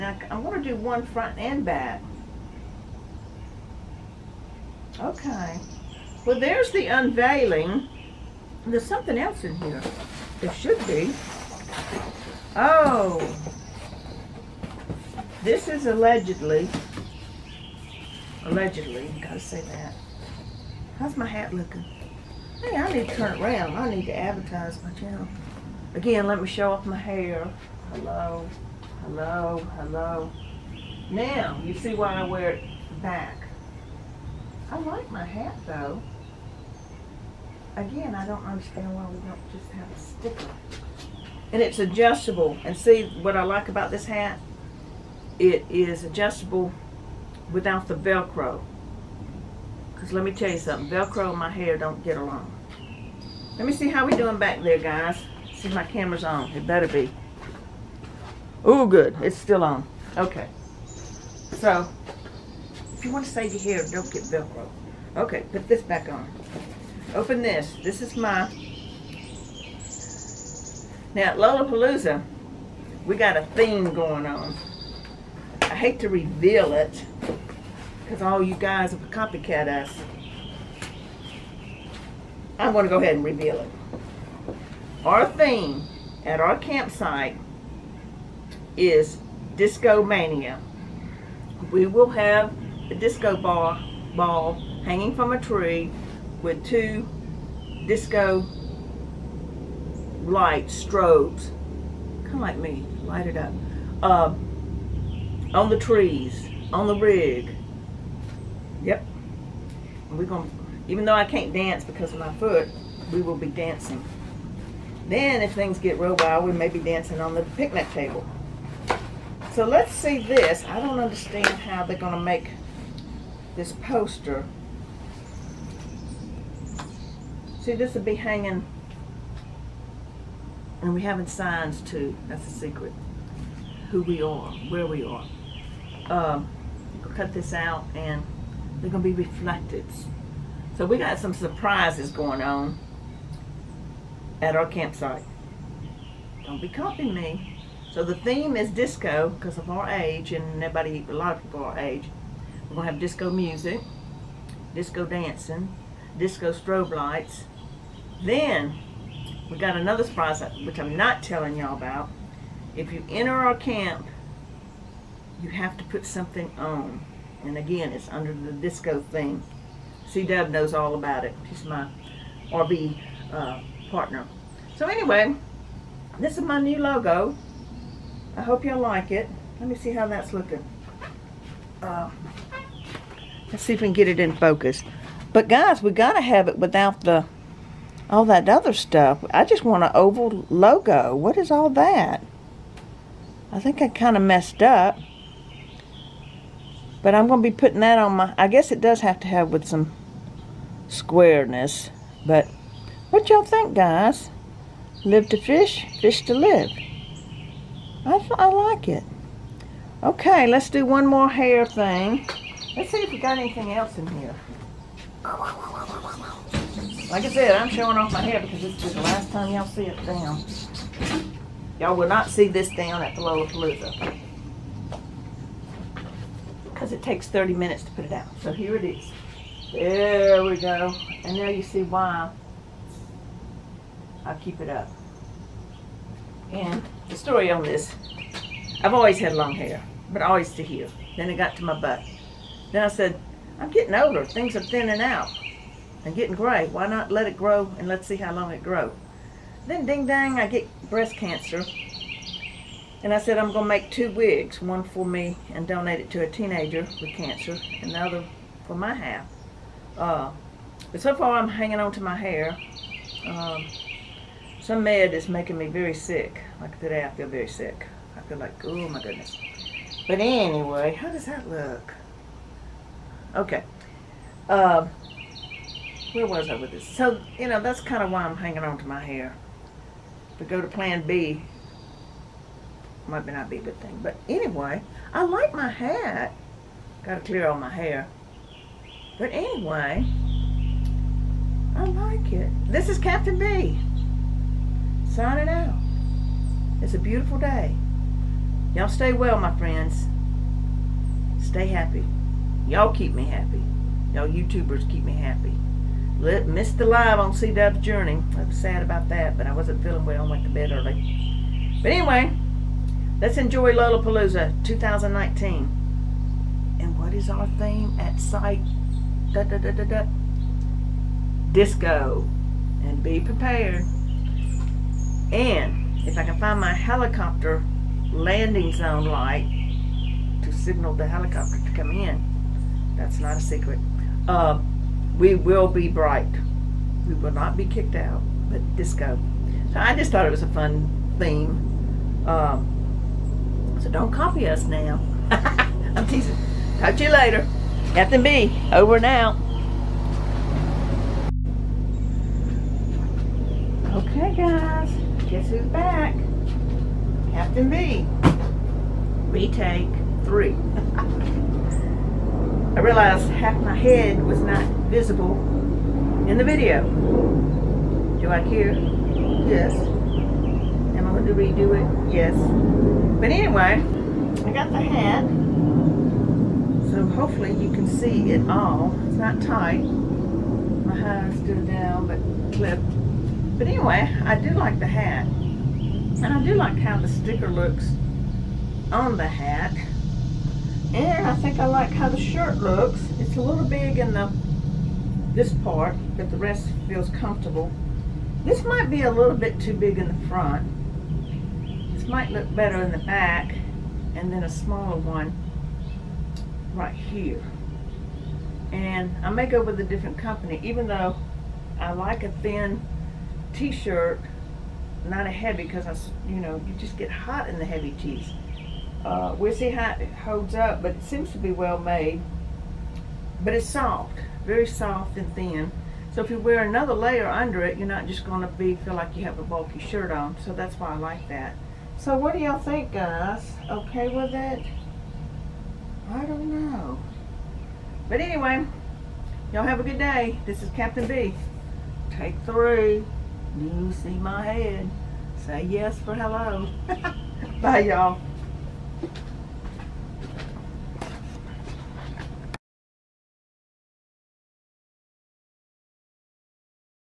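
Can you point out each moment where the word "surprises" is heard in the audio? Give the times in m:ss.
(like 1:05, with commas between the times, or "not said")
2:21, 2:40.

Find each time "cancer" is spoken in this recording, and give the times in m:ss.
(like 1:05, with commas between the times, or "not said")
4:11, 4:17.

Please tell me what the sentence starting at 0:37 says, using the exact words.
Again, I don't understand why we don't just have a sticker.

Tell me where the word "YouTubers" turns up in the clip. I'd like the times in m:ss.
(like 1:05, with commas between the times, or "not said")
5:04.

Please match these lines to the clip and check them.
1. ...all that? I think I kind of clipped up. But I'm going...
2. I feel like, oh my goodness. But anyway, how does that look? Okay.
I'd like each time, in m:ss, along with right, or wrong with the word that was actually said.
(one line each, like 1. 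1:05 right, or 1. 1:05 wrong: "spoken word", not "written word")
1. 3:11 wrong: "messed", not "clipped"
2. 4:28 right.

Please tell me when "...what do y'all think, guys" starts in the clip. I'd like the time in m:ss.
7:12.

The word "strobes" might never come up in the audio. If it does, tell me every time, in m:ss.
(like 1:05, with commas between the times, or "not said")
1:40, 2:36.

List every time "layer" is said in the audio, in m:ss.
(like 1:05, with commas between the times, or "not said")
7:06.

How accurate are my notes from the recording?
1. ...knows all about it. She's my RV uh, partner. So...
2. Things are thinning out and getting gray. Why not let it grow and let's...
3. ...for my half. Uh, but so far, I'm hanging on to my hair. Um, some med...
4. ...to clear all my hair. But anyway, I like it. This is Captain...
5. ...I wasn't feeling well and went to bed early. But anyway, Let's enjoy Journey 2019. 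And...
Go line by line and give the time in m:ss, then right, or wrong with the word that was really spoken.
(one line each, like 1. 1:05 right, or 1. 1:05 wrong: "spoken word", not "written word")
1. 2:50 right
2. 4:04 right
3. 4:18 right
4. 4:47 right
5. 5:09 wrong: "Lollapalooza", not "Journey".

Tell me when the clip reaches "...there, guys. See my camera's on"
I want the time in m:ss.
0:54.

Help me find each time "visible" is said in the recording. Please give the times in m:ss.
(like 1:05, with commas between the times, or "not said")
6:04.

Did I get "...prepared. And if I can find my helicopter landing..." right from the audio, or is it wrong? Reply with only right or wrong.
right.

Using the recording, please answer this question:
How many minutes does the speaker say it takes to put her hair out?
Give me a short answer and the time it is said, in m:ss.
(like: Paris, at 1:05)
30, at 3:47.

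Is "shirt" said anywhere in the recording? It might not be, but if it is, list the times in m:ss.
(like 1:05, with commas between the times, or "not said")
6:32, 6:53, 7:09.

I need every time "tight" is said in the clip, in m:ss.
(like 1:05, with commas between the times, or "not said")
6:19.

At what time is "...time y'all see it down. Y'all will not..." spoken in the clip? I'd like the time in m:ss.
3:39.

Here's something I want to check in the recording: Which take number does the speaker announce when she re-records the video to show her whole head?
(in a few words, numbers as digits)
3.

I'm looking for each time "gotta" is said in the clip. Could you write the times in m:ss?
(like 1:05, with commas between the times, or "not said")
0:19, 3:05.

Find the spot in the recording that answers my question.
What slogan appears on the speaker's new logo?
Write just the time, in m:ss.
3:25.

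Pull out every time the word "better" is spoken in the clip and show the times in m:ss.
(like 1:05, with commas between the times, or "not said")
0:56, 6:42.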